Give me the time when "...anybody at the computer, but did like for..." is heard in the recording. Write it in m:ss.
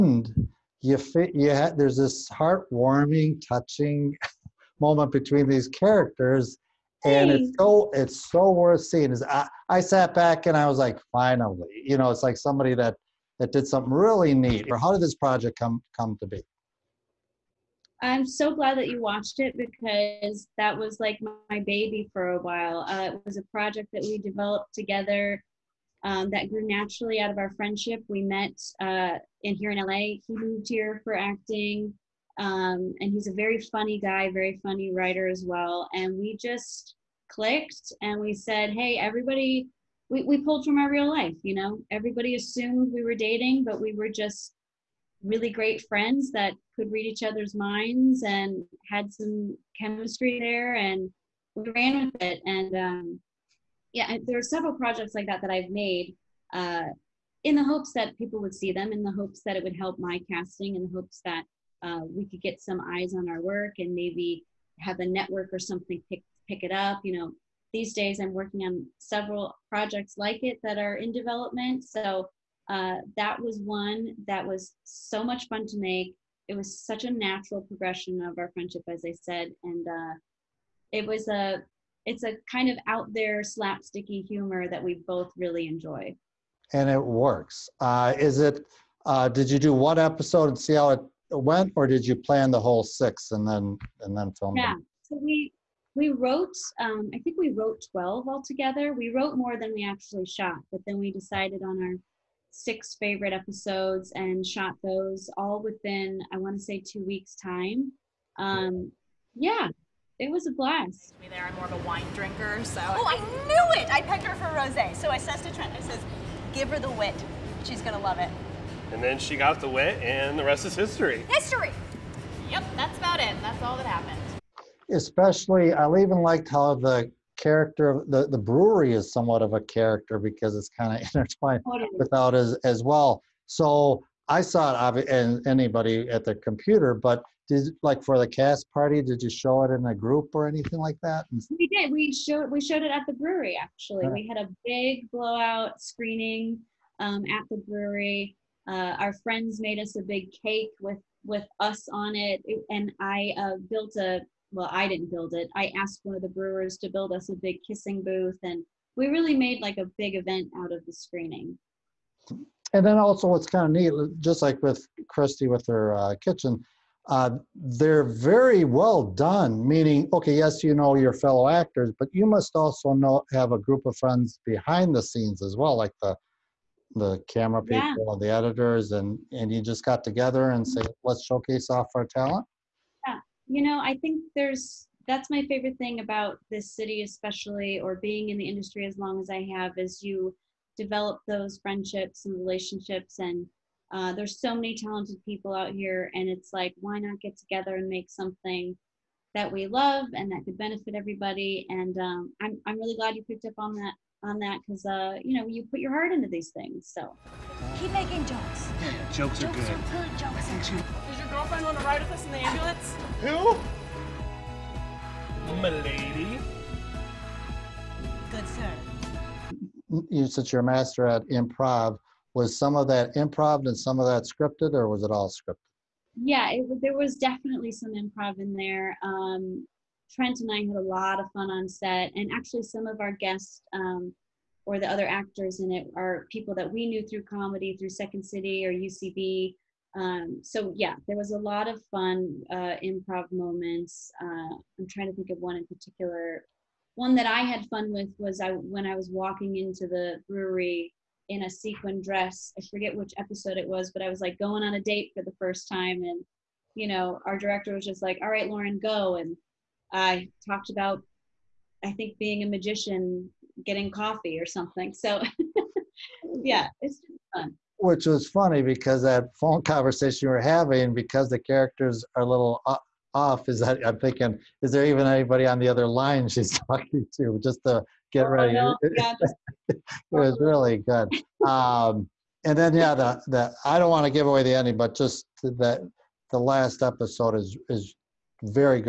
2:15.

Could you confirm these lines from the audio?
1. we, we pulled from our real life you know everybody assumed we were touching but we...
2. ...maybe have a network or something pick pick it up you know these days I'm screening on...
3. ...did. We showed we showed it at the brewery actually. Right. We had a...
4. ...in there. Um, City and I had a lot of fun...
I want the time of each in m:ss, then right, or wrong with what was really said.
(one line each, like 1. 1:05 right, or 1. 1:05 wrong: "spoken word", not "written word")
1. 0:40 wrong: "dating", not "touching"
2. 1:03 wrong: "working", not "screening"
3. 2:21 right
4. 3:48 wrong: "Trent", not "City".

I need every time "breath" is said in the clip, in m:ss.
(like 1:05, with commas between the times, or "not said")
not said.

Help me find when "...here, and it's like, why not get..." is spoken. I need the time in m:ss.
3:15.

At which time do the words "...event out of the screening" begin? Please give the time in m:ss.
2:40.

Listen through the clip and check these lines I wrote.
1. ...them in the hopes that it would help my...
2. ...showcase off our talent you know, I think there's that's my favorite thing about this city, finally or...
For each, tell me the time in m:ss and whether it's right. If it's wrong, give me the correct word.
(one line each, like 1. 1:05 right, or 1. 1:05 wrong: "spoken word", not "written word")
1. 0:58 right
2. 3:01 wrong: "especially", not "finally".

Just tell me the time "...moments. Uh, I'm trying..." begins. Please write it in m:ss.
4:03.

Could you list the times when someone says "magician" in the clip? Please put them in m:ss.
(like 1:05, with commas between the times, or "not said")
4:22.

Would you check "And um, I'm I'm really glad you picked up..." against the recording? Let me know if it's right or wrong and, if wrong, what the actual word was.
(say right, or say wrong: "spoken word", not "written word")
right.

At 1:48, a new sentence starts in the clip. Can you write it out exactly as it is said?
Um, yeah, it was a blast.